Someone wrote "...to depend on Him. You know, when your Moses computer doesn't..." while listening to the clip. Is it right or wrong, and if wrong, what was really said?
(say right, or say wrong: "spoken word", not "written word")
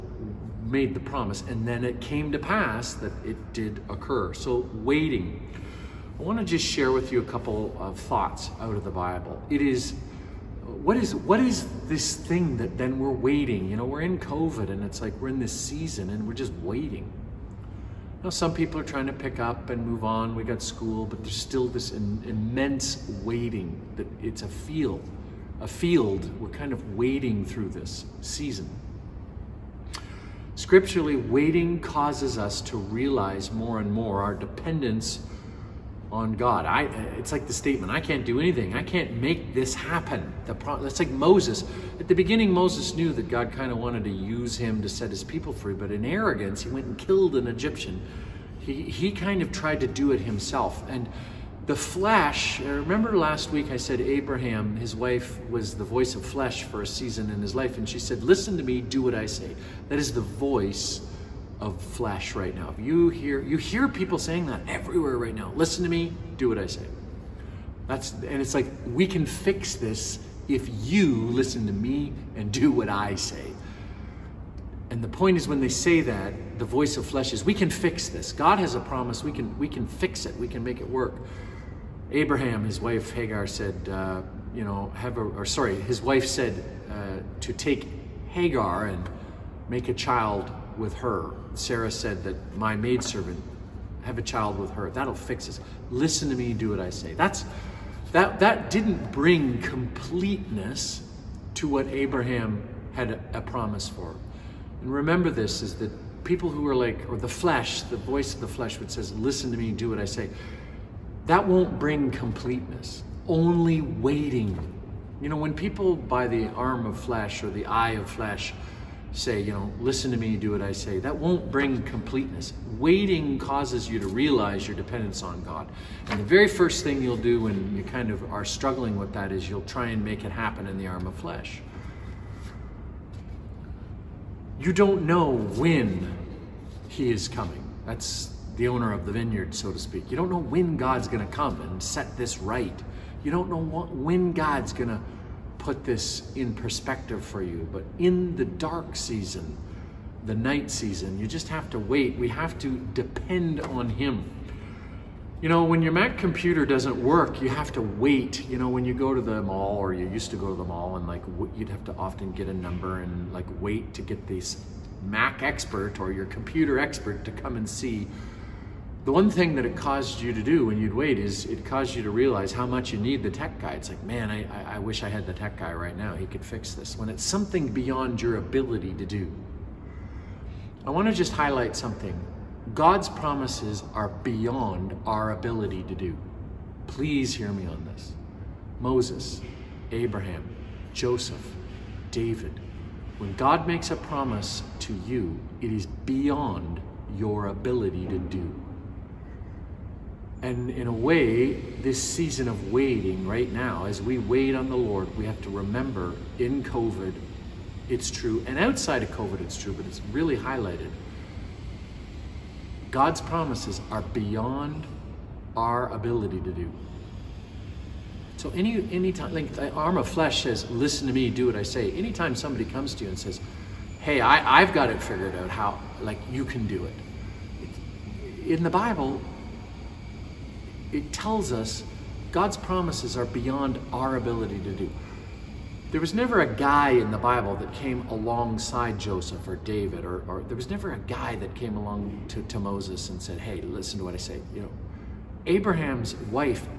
wrong: "Mac", not "Moses".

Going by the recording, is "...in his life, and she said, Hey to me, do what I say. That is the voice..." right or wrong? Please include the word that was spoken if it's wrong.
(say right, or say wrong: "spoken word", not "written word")
wrong: "Listen", not "Hey".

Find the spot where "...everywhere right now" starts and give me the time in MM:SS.
01:04.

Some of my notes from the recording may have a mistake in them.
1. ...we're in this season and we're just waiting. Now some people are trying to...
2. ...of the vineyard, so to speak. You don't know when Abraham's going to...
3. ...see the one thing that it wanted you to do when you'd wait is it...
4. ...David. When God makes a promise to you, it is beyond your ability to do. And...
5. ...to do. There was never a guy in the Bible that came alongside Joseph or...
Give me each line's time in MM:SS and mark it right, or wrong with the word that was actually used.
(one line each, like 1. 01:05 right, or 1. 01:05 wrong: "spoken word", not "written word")
1. 00:15 right
2. 02:18 wrong: "God", not "Abraham"
3. 02:47 wrong: "caused", not "wanted"
4. 03:12 right
5. 03:54 right.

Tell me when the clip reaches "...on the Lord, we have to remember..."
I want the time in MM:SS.
03:24.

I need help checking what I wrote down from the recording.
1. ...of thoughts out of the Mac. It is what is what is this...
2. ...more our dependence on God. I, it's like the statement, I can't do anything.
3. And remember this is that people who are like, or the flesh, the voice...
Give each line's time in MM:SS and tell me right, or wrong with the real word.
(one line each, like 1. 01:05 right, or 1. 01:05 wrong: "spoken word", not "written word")
1. 00:07 wrong: "Bible", not "Mac"
2. 00:33 right
3. 01:44 right.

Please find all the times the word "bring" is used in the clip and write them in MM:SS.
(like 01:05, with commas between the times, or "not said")
01:39, 01:51, 02:01.